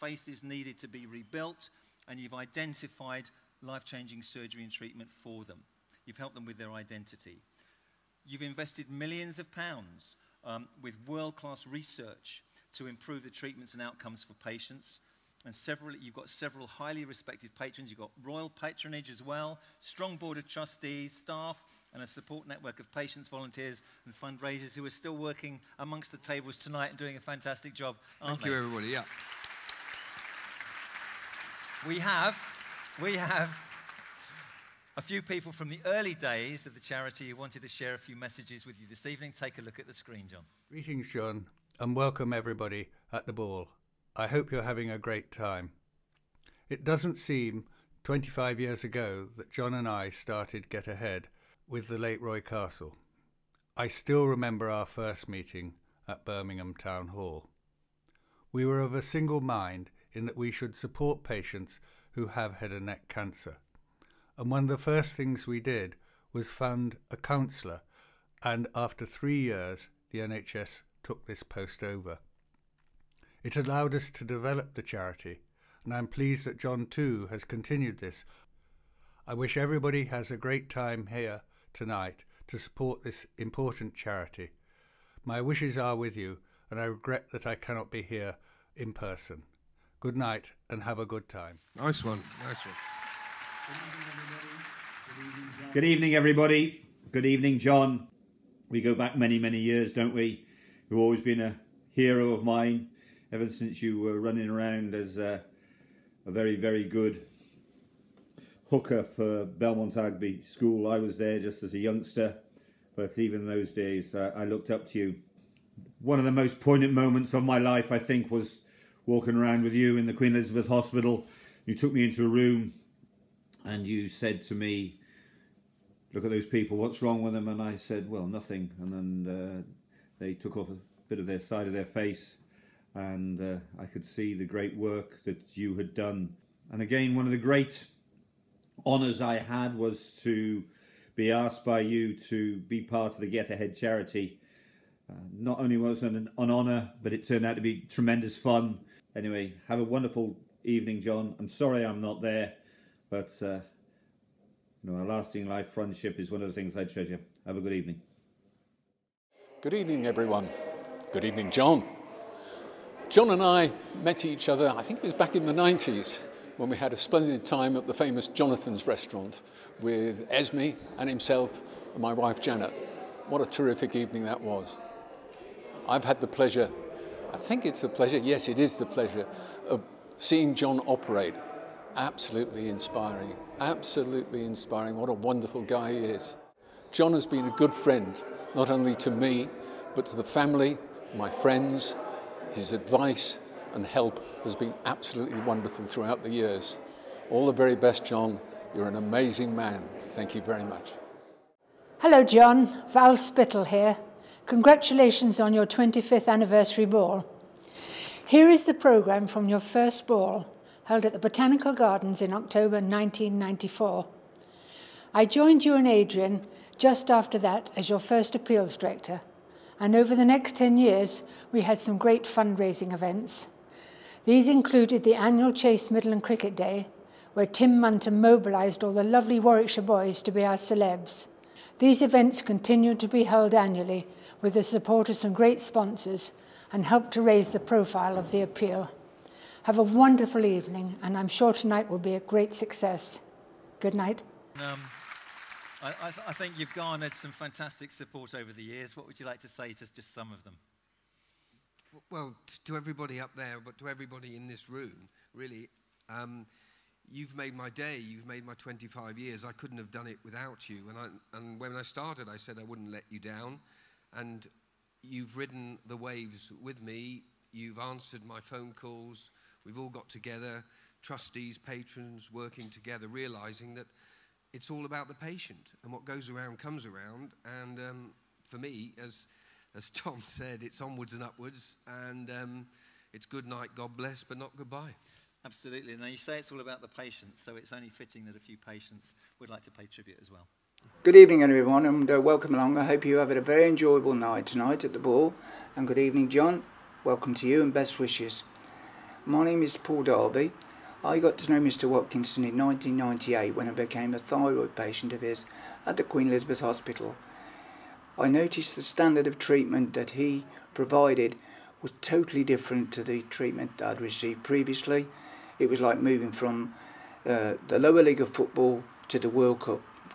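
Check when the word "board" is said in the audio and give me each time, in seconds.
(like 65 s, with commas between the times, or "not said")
20 s.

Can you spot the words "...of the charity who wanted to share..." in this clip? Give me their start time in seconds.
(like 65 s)
36 s.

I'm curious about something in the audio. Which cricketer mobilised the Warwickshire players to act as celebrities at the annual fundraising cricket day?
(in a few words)
Tim Munton.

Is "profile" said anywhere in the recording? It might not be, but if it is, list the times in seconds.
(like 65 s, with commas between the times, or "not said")
237 s.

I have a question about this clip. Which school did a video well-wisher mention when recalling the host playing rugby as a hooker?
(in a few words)
Belmont Abbey School.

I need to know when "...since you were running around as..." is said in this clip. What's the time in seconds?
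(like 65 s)
103 s.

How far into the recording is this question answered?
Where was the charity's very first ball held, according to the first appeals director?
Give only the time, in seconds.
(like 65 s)
211 s.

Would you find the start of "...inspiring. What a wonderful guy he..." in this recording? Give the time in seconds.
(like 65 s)
184 s.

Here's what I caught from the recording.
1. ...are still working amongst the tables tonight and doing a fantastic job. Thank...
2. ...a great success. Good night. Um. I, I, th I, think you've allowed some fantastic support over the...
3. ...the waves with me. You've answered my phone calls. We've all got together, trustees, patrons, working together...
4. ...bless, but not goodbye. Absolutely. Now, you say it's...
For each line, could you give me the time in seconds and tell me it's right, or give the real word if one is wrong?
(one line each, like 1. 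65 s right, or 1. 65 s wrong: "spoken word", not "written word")
1. 24 s right
2. 242 s wrong: "garnered", not "allowed"
3. 265 s right
4. 283 s right.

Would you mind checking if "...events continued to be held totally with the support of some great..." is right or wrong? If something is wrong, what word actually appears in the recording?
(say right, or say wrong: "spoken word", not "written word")
wrong: "annually", not "totally".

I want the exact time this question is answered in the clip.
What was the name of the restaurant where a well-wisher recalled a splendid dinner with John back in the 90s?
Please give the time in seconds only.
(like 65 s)
168 s.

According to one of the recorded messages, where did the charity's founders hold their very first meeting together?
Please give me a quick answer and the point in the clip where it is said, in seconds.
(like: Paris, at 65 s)
Birmingham Town Hall, at 56 s.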